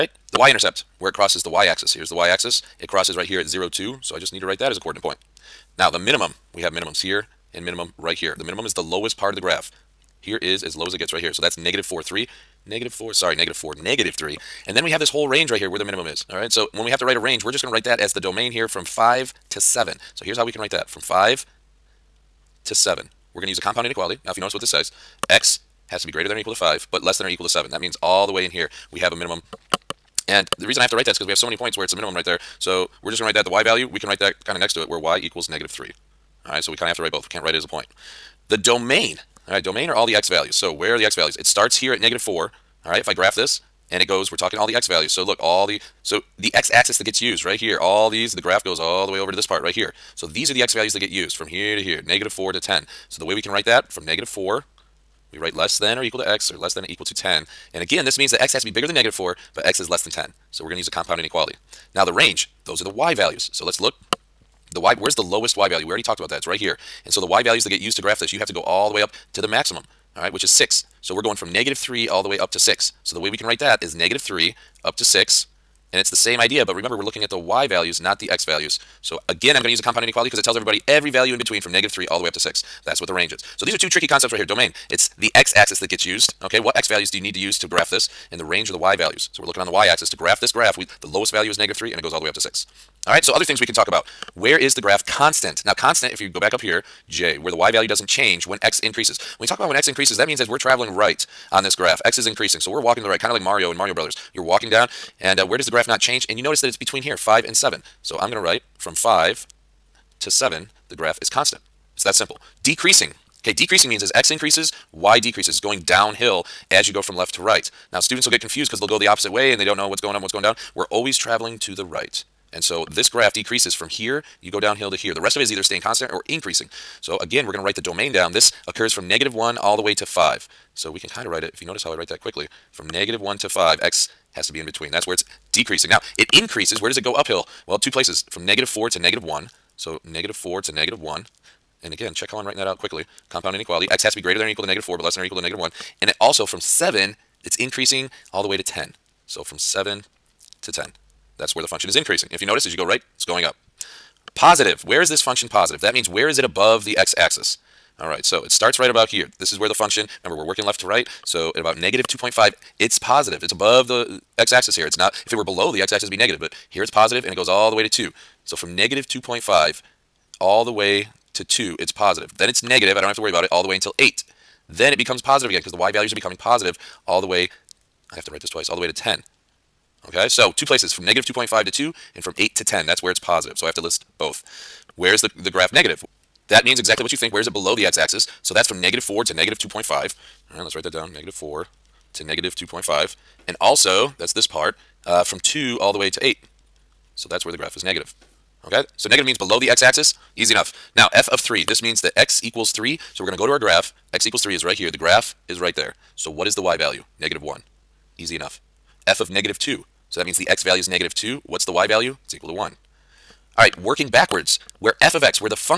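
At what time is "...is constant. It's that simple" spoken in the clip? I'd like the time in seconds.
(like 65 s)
111 s.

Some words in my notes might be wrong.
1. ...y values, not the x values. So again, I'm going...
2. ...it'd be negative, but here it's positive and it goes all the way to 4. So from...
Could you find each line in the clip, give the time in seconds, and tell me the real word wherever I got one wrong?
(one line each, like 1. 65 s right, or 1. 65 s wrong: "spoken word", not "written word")
1. 77 s right
2. 166 s wrong: "2", not "4".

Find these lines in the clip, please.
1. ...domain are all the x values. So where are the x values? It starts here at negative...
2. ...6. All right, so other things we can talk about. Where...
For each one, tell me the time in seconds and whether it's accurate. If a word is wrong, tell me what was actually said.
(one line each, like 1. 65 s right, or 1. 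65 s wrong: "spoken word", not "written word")
1. 39 s right
2. 92 s right.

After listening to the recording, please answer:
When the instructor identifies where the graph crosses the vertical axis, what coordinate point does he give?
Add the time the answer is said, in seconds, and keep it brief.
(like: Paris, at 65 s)
(0, 2), at 3 s.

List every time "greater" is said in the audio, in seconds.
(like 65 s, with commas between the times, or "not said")
26 s, 144 s.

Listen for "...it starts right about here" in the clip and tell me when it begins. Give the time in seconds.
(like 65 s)
158 s.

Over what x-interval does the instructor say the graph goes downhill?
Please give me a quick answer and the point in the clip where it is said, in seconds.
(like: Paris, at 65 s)
-1 to 5, at 129 s.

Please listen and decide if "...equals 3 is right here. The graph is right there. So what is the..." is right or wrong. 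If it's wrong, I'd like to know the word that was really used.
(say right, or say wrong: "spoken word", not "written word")
right.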